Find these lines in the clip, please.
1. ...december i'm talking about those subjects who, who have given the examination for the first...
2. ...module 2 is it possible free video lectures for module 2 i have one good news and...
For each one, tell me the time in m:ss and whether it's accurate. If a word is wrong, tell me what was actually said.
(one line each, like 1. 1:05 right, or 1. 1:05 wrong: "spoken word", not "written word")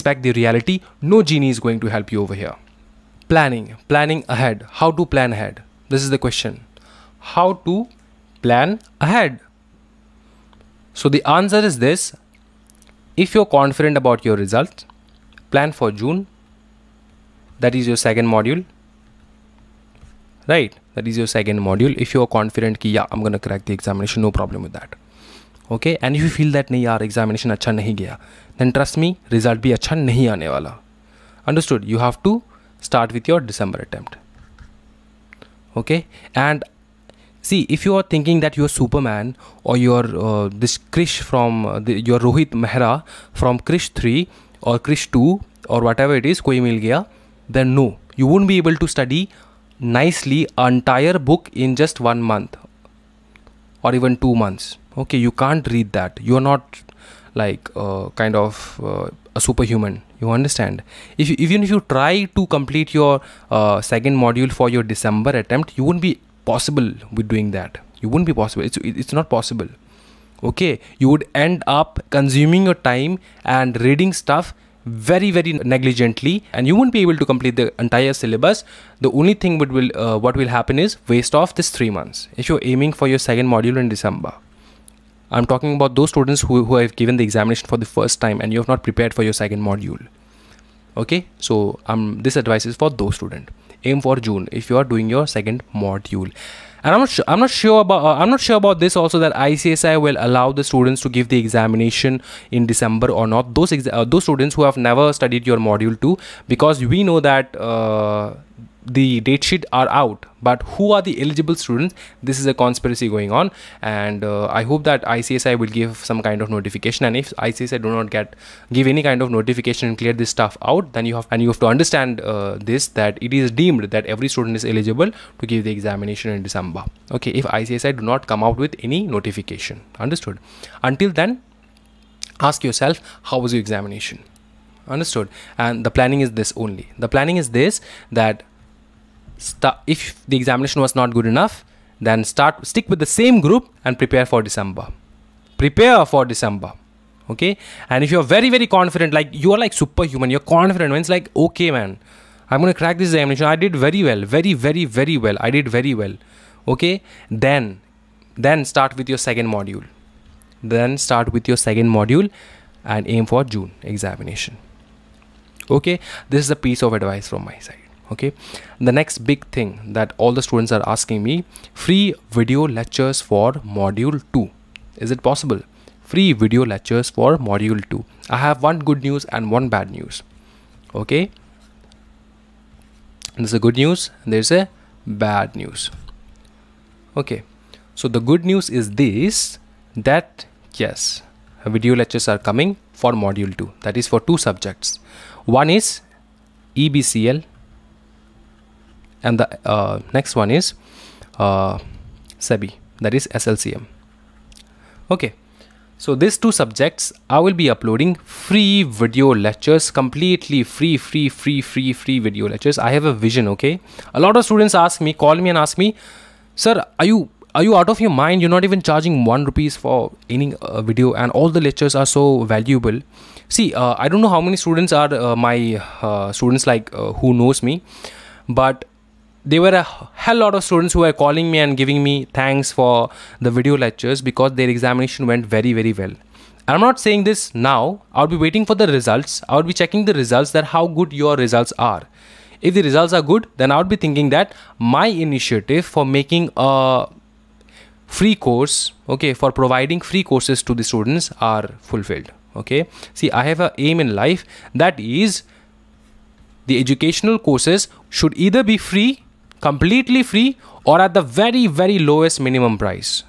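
1. 1:23 wrong: "students", not "subjects"
2. 2:53 right.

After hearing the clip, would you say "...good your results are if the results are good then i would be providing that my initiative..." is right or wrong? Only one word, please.
wrong.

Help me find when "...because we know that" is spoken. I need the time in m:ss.
1:46.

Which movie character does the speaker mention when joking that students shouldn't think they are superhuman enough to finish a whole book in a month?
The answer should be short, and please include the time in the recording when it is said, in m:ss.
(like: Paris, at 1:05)
Rohit Mehra, at 0:42.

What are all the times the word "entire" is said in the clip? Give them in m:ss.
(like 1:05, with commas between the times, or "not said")
0:50, 1:17.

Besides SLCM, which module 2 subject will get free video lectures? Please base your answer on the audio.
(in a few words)
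EBCL.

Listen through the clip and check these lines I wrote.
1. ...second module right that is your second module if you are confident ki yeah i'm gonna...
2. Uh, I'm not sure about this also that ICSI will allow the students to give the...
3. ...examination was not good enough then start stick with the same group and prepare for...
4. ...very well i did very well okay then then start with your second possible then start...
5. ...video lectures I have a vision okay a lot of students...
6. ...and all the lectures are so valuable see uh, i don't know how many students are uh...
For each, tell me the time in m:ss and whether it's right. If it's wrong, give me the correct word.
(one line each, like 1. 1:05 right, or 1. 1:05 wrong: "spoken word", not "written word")
1. 0:18 right
2. 1:38 right
3. 2:20 right
4. 2:34 wrong: "module", not "possible"
5. 3:32 right
6. 3:41 right.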